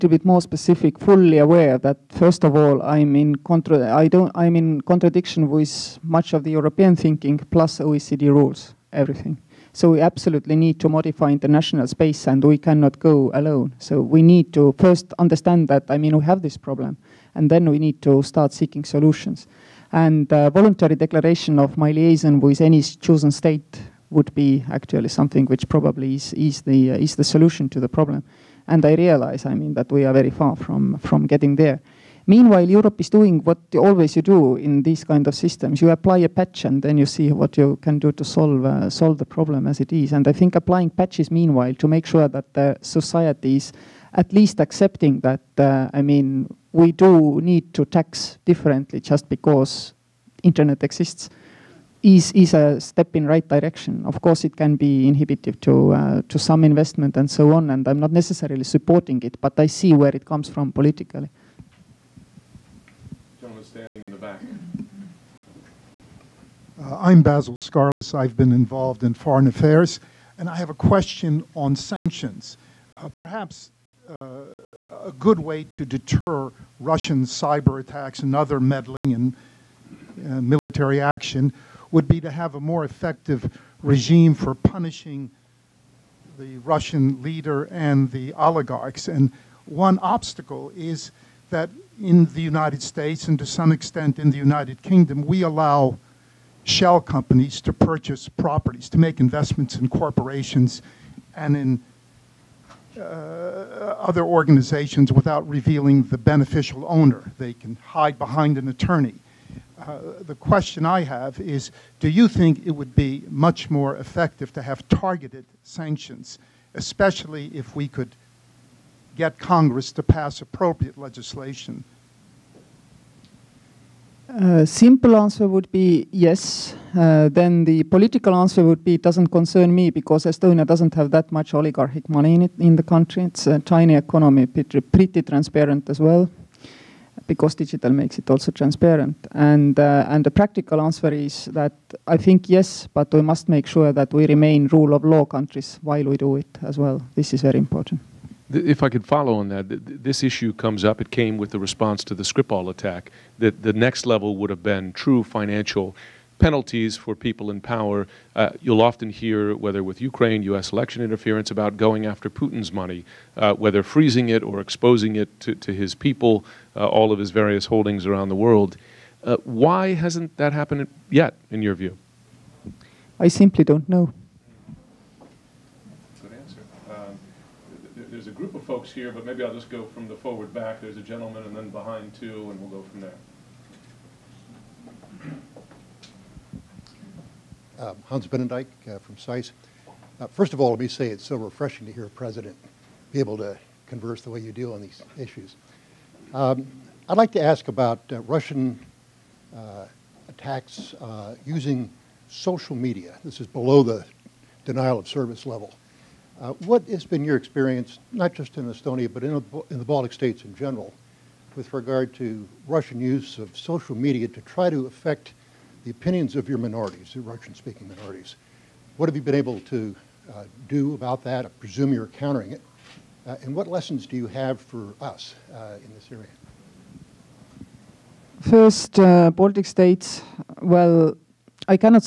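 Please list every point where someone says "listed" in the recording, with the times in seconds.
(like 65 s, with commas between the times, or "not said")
not said.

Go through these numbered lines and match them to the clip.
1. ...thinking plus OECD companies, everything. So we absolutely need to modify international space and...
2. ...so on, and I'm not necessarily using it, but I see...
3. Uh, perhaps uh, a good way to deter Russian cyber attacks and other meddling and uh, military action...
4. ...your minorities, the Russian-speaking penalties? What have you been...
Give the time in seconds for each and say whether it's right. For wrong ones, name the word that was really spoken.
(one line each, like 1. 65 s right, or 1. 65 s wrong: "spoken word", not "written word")
1. 6 s wrong: "rules", not "companies"
2. 57 s wrong: "supporting", not "using"
3. 72 s right
4. 216 s wrong: "minorities", not "penalties".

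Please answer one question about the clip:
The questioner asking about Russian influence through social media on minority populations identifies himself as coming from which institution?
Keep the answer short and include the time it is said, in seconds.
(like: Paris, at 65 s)
SAIS, at 189 s.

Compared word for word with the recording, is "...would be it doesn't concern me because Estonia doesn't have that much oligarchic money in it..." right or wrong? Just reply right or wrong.
right.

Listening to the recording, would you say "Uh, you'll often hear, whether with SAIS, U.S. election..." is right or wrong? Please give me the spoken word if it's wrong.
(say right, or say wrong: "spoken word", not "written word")
wrong: "Ukraine", not "SAIS".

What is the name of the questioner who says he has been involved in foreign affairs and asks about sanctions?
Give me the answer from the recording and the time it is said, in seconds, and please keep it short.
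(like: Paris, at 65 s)
Basil Scarless, at 67 s.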